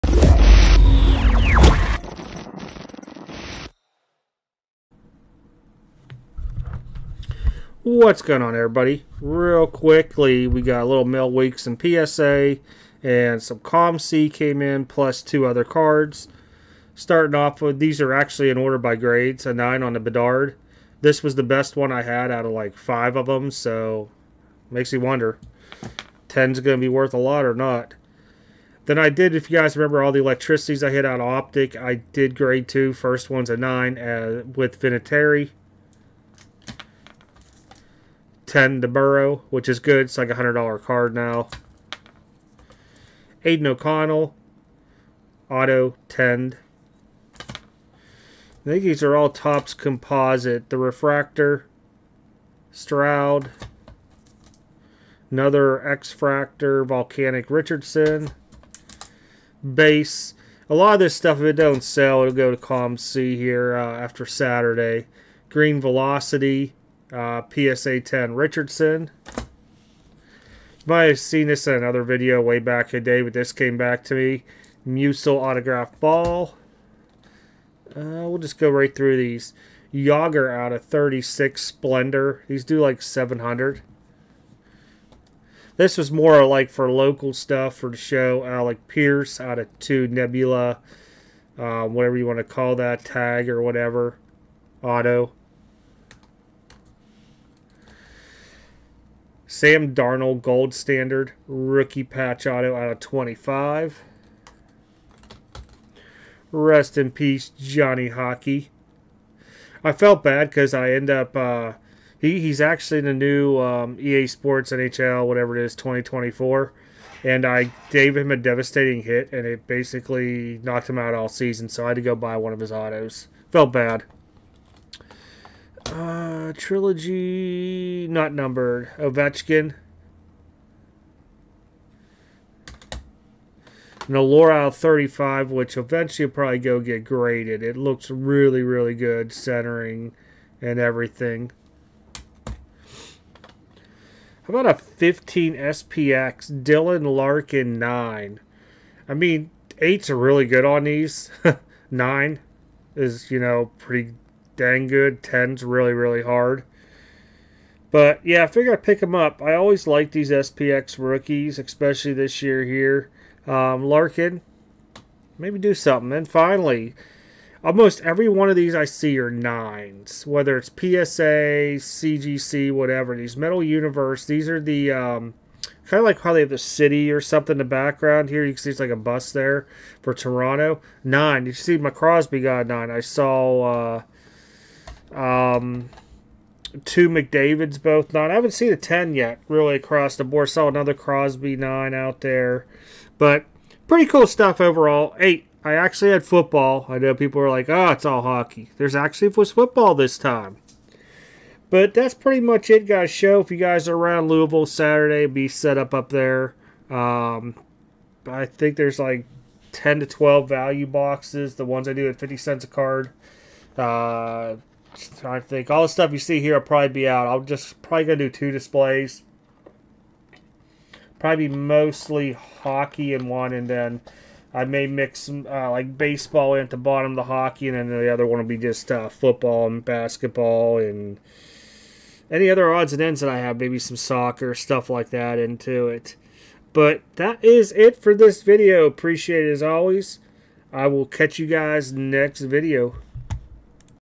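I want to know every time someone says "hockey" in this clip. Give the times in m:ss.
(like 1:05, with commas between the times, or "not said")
1:48, 3:18, 3:42, 3:47.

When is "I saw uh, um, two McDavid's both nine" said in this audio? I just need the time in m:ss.
3:02.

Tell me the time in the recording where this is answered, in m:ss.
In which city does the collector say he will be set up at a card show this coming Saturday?
3:24.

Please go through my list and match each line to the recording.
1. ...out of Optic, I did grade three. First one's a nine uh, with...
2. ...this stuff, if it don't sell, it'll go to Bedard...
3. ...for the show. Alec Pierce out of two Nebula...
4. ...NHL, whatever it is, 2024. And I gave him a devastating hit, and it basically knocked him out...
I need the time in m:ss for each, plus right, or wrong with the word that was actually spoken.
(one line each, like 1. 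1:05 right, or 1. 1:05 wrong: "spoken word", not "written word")
1. 0:31 wrong: "two", not "three"
2. 1:00 wrong: "COMC", not "Bedard"
3. 1:27 right
4. 1:54 right.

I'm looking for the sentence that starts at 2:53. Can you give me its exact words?
These Metal Universe, these are the um, kind of like how they have the city or something in the background here.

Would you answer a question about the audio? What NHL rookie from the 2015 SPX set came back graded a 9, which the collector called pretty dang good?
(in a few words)
Dylan Larkin.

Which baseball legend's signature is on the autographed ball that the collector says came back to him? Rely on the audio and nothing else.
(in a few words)
Musial.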